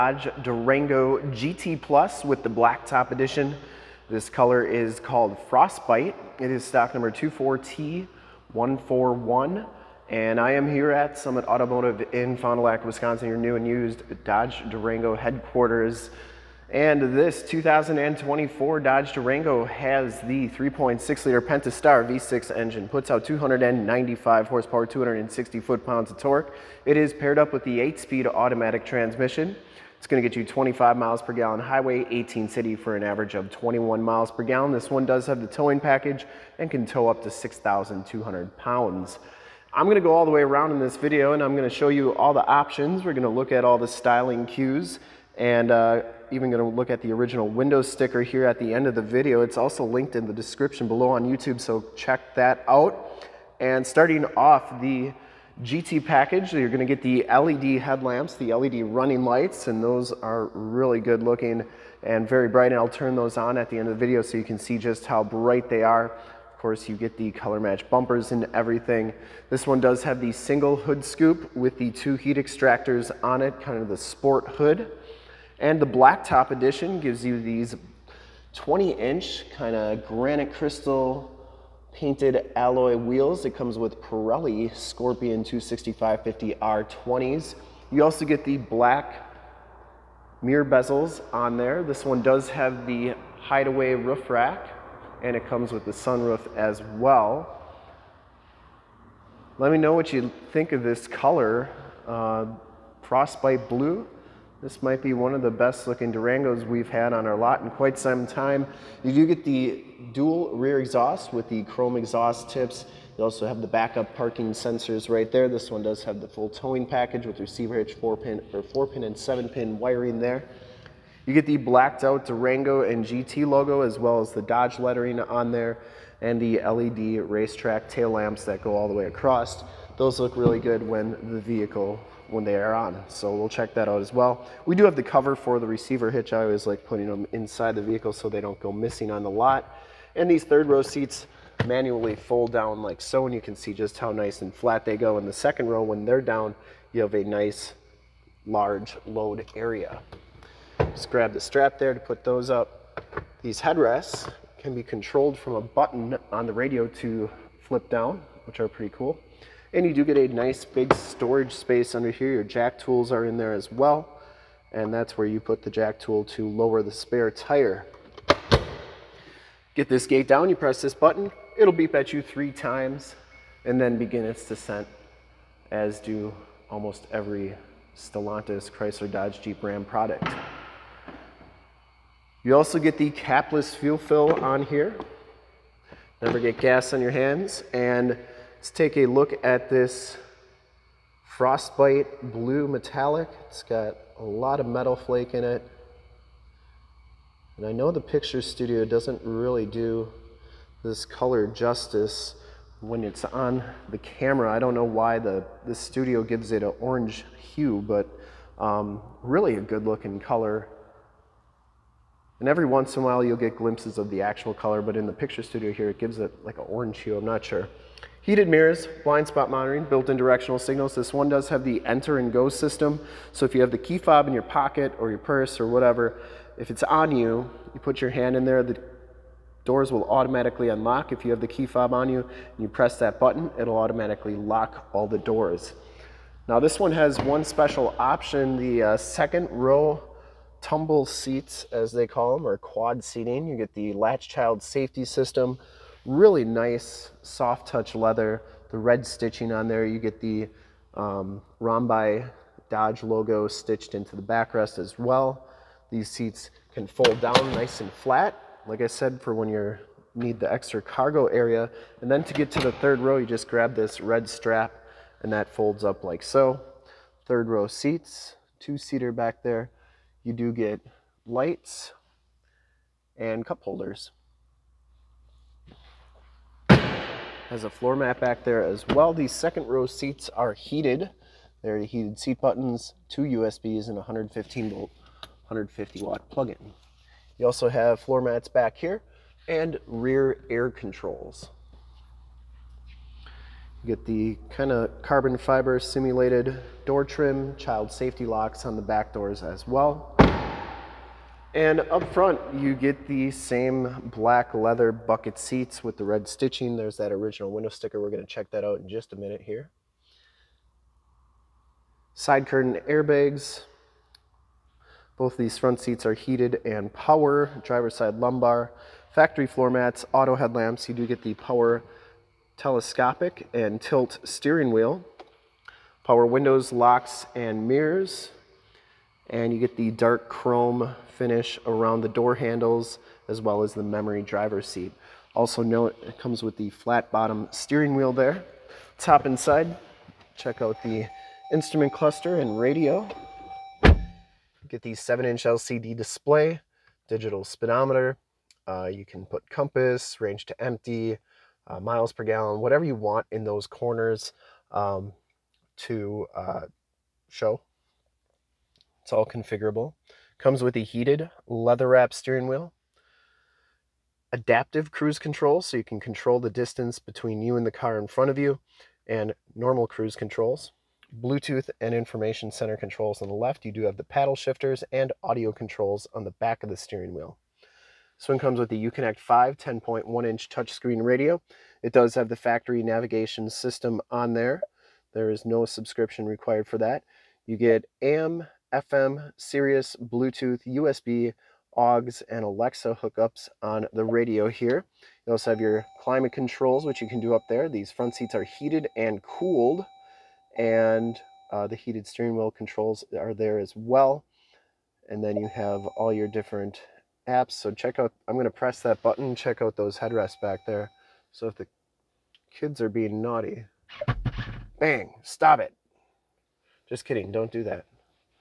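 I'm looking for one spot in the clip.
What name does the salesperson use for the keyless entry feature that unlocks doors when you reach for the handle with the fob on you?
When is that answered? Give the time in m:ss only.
3:41.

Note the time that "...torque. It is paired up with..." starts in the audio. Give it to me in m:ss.
0:26.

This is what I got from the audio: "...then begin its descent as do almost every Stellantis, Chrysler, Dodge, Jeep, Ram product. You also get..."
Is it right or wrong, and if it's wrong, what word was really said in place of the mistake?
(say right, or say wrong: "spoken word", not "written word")
right.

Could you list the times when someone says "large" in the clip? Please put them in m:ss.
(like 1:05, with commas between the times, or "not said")
2:28.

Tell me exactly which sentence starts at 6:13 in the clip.
You do have the paddle shifters and audio controls on the back of the steering wheel.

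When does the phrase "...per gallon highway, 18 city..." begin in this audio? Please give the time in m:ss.
0:31.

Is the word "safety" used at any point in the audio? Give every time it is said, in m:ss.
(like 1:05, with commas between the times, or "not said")
4:04, 4:57.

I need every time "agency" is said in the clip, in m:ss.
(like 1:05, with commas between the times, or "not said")
not said.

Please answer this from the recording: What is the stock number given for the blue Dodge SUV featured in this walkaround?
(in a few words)
24T141.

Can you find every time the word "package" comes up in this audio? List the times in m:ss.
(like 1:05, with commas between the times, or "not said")
0:35, 0:56, 1:56.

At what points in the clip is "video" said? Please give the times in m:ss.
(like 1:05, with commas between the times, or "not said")
0:40, 0:49, 1:04.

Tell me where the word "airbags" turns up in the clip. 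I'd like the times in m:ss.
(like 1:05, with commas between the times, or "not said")
5:12.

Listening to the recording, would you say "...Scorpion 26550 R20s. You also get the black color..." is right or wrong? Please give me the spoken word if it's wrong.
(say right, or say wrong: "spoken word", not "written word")
wrong: "mirror", not "color".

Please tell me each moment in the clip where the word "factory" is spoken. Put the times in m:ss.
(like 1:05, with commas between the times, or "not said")
5:19, 6:22.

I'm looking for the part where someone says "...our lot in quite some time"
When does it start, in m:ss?
1:47.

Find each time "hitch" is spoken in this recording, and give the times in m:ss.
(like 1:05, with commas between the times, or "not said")
1:57, 2:16.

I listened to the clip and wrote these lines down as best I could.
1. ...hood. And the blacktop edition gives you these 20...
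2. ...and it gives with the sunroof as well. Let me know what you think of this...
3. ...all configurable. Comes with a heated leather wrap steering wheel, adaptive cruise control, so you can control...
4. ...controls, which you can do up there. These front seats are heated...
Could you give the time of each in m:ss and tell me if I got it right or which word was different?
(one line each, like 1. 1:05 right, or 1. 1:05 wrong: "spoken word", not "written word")
1. 1:14 right
2. 1:35 wrong: "comes", not "gives"
3. 5:59 right
4. 6:36 right.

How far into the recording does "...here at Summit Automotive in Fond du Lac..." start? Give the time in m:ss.
0:10.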